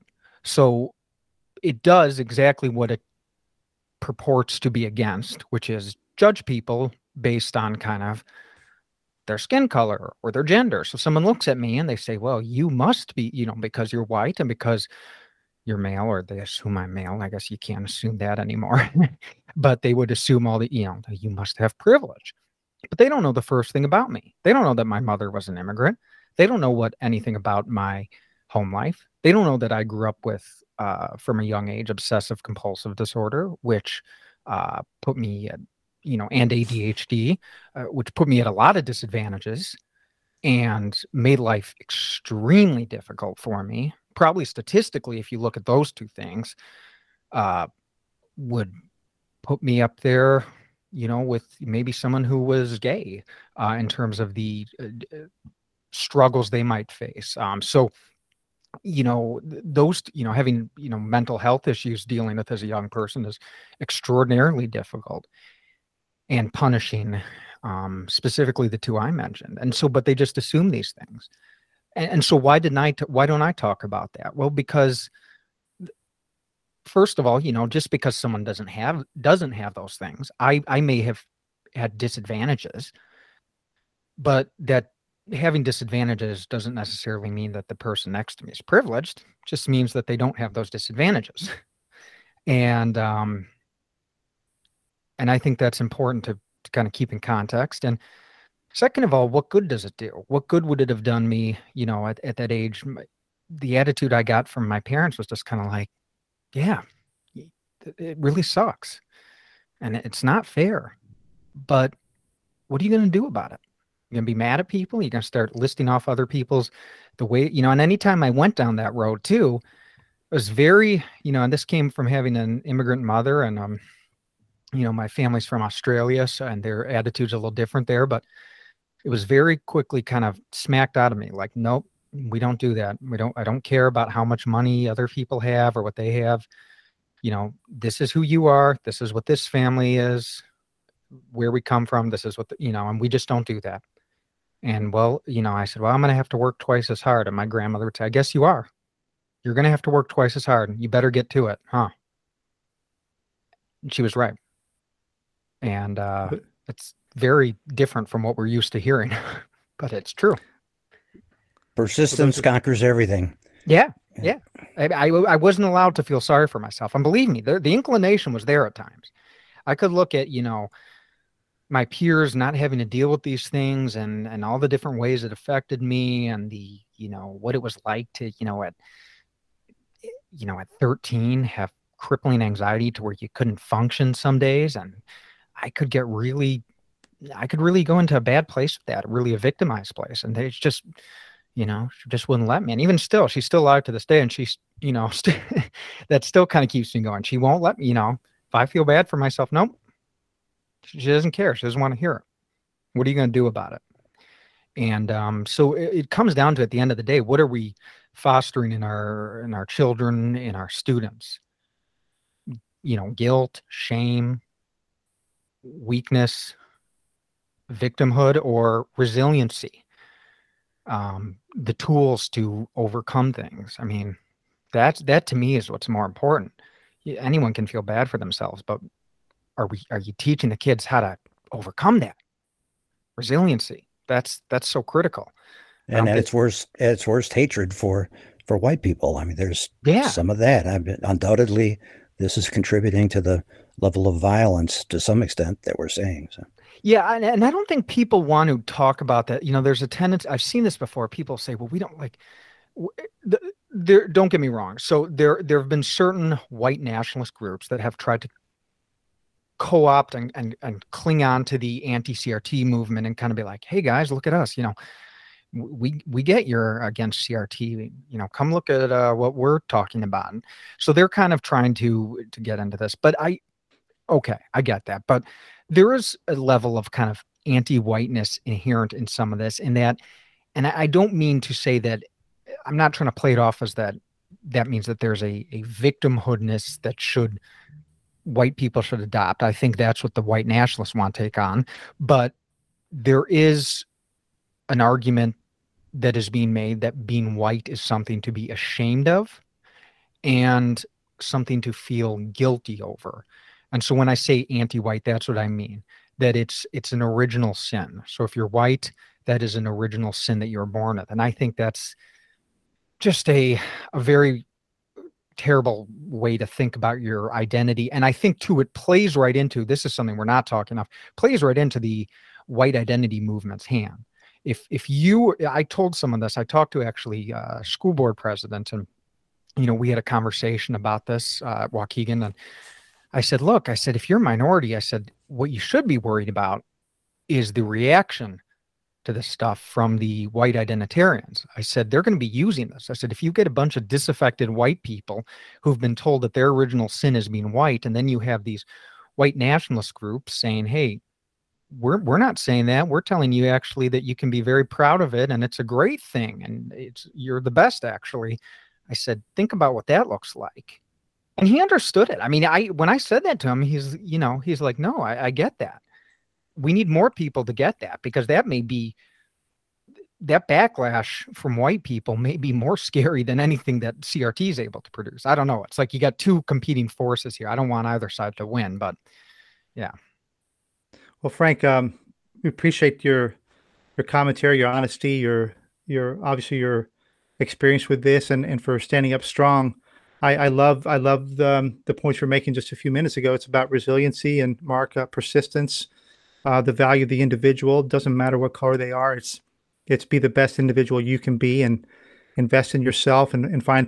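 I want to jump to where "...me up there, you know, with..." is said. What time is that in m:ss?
0:49.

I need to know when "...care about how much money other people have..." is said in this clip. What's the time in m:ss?
2:13.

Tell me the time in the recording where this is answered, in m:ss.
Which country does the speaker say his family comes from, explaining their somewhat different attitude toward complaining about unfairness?
2:05.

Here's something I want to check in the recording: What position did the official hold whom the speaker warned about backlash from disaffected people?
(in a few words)
School board president.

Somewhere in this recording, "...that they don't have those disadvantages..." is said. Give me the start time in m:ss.
1:29.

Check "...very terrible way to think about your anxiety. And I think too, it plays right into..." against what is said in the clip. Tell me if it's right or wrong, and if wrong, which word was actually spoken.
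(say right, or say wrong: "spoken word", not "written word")
wrong: "identity", not "anxiety".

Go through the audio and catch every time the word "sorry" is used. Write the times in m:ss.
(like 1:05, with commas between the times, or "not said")
2:46.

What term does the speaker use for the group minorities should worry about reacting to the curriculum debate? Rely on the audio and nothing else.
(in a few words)
White identitarians.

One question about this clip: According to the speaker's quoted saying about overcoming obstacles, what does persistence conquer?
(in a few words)
Everything.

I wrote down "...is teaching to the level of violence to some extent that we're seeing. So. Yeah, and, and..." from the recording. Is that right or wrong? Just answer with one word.
wrong.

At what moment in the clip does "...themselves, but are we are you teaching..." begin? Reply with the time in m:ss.
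3:48.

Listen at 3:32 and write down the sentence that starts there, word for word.
You know, guilt, shame, weakness, victimhood, or resiliency.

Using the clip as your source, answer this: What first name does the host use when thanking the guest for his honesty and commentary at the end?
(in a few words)
Frank.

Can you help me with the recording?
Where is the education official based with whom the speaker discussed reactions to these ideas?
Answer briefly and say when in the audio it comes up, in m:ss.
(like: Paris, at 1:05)
Waukegan, at 5:31.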